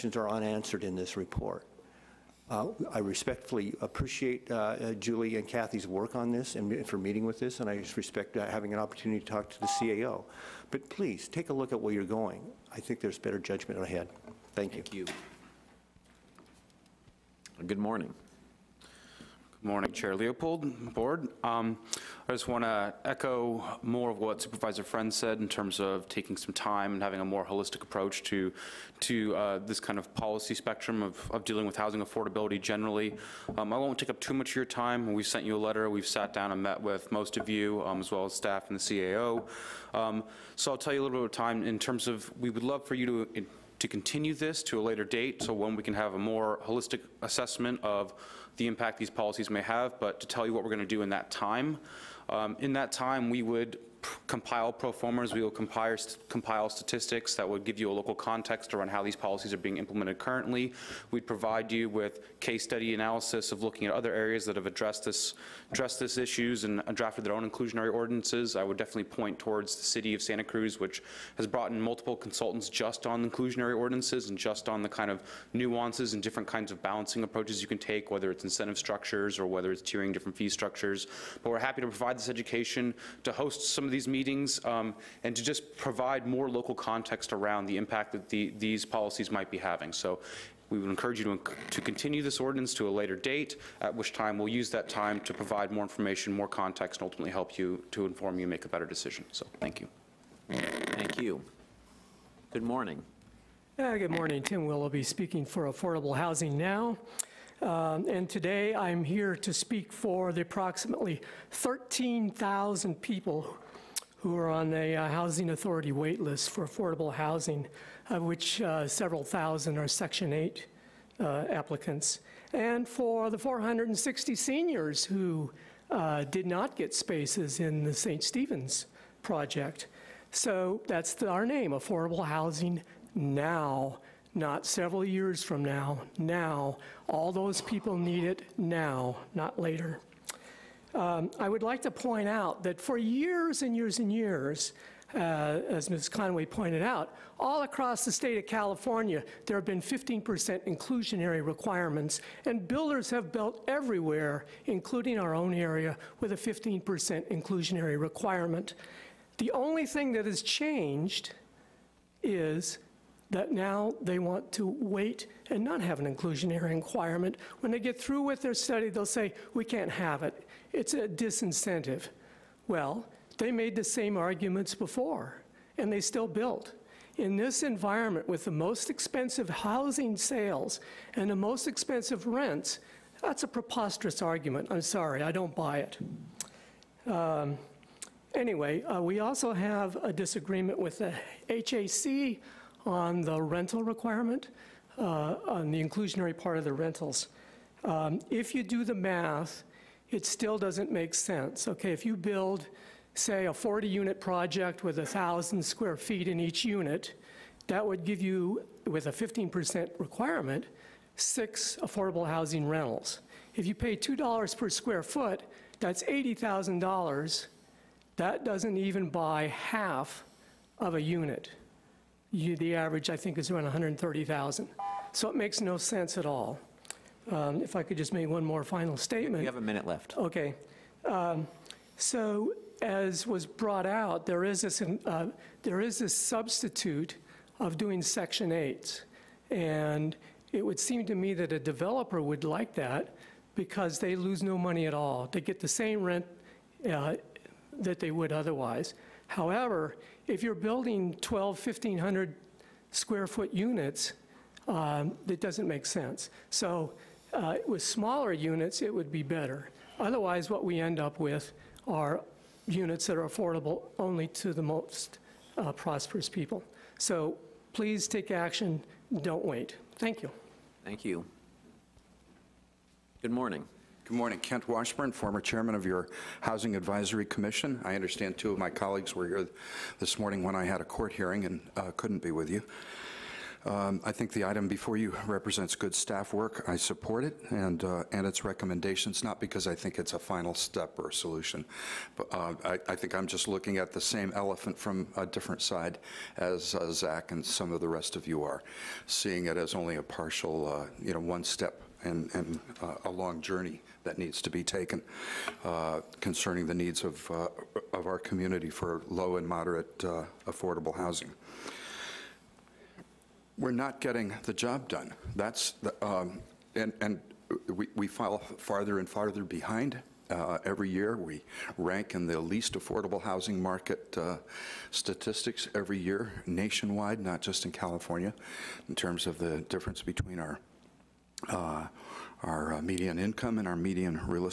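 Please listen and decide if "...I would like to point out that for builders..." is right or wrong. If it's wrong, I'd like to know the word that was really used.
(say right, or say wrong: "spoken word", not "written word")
wrong: "years", not "builders".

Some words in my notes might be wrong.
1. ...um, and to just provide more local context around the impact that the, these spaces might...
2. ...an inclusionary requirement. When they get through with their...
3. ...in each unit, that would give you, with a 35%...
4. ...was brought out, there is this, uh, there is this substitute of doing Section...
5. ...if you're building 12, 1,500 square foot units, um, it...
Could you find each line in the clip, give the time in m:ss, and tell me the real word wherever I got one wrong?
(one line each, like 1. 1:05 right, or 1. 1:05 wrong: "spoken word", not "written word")
1. 1:24 wrong: "policies", not "spaces"
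2. 2:45 right
3. 3:26 wrong: "15", not "35"
4. 3:53 right
5. 4:10 right.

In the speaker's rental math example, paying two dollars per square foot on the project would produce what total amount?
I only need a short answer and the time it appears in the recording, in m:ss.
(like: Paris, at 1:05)
$80,000, at 3:36.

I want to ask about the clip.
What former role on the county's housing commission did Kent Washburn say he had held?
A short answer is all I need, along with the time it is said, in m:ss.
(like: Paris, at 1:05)
former chairman, at 4:35.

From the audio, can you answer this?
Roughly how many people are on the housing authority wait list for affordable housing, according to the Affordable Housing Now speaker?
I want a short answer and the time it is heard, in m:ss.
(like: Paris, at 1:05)
13,000, at 1:51.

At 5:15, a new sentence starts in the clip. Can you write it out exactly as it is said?
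That's the, um, and, and we, we fall farther and farther behind uh, every year.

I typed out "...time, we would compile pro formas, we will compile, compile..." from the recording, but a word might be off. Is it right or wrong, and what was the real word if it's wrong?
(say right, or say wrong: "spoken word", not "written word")
right.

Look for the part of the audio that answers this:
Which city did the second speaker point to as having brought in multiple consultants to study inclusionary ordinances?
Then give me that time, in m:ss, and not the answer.
1:09.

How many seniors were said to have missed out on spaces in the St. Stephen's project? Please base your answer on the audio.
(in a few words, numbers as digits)
460.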